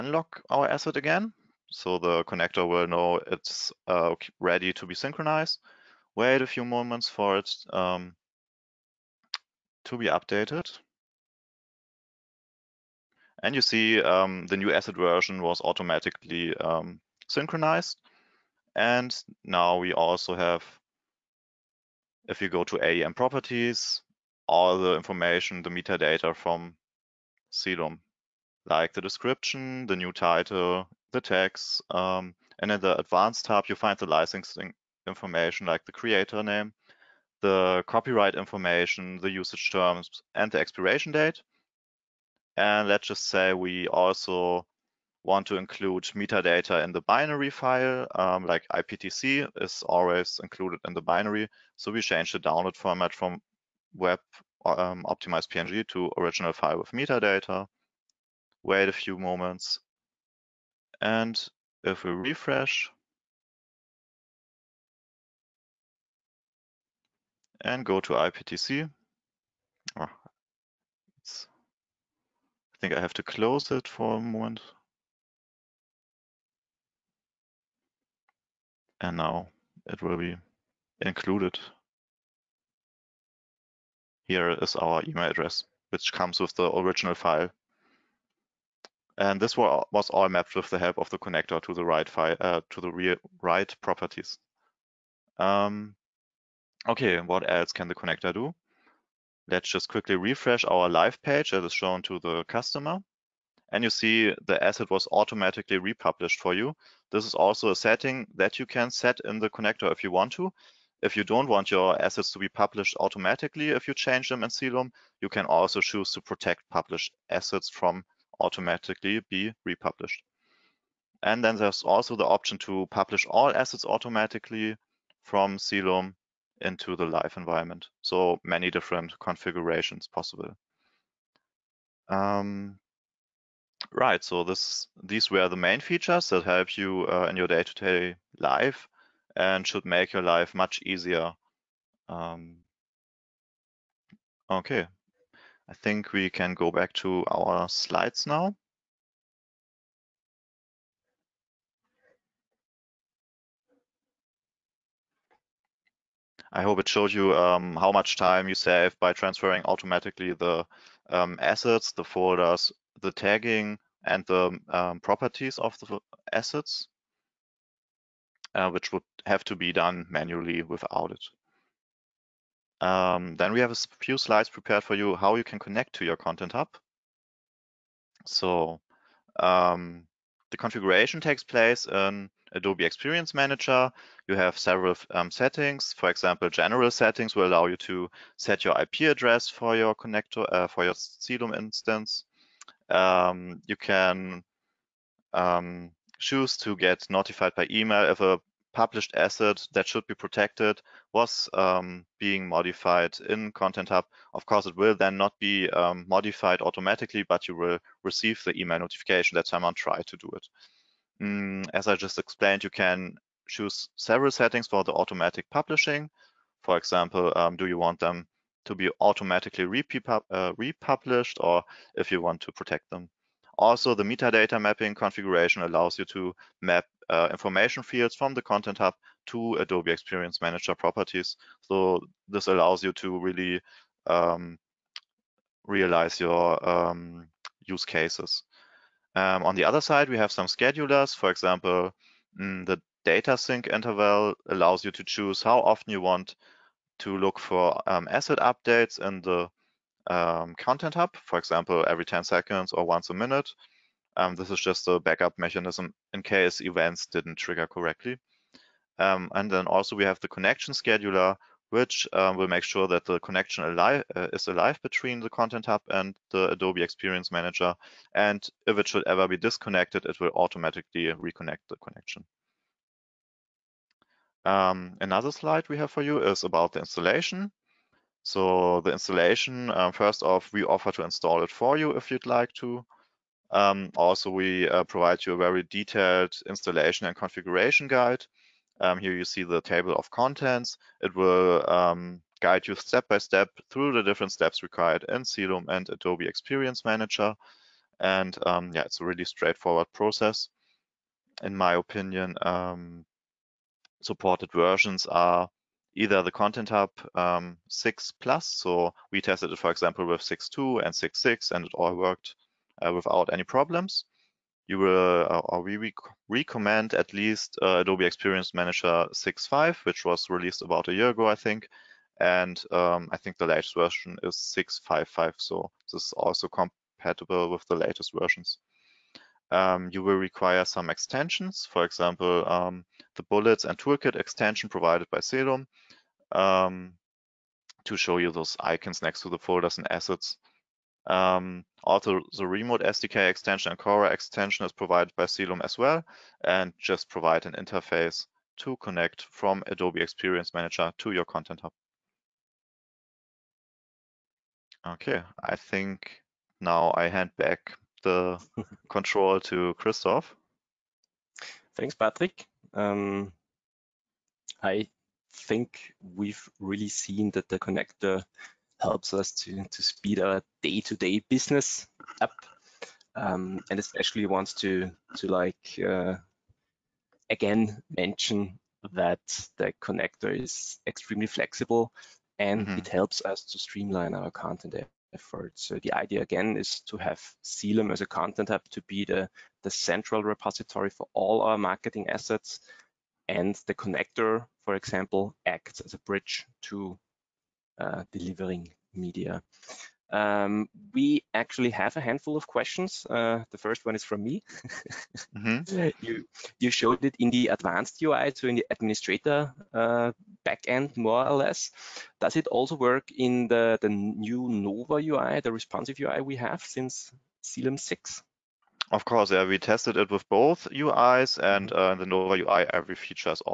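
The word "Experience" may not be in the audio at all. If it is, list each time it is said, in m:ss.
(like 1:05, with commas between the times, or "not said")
3:02, 3:49, 4:26, 4:56, 5:18, 5:50.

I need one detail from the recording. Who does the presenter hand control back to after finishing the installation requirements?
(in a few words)
Christoph.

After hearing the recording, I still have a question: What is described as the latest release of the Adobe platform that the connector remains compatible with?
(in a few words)
6.5.5.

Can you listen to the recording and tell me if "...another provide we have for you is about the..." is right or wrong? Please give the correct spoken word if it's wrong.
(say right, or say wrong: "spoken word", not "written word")
wrong: "slide", not "provide".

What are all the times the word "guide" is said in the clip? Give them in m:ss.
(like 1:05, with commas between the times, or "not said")
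4:47, 4:52.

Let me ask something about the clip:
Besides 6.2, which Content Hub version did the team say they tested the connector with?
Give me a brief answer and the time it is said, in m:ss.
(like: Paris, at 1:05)
6.6, at 5:10.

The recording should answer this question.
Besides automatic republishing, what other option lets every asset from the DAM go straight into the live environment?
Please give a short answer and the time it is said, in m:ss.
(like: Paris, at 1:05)
publish all assets automatically, at 2:02.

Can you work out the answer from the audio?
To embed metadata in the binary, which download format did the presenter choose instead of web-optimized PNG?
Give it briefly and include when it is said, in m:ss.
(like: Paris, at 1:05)
original file with metadata, at 0:56.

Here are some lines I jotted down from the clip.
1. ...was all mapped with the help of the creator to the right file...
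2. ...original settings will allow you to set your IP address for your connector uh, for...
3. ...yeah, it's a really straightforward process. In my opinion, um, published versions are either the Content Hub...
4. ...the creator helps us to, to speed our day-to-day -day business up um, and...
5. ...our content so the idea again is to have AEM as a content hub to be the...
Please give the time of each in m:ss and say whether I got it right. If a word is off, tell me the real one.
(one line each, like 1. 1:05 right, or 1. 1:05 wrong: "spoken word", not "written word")
1. 1:29 wrong: "connector", not "creator"
2. 3:06 wrong: "general", not "original"
3. 4:58 wrong: "supported", not "published"
4. 6:07 wrong: "connector", not "creator"
5. 6:24 wrong: "Celum", not "AEM".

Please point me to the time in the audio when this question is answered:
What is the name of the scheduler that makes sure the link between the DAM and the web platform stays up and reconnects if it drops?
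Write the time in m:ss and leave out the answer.
4:20.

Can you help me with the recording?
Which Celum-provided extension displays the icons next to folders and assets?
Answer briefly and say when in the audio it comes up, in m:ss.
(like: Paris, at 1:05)
bullets and toolkit extension, at 5:33.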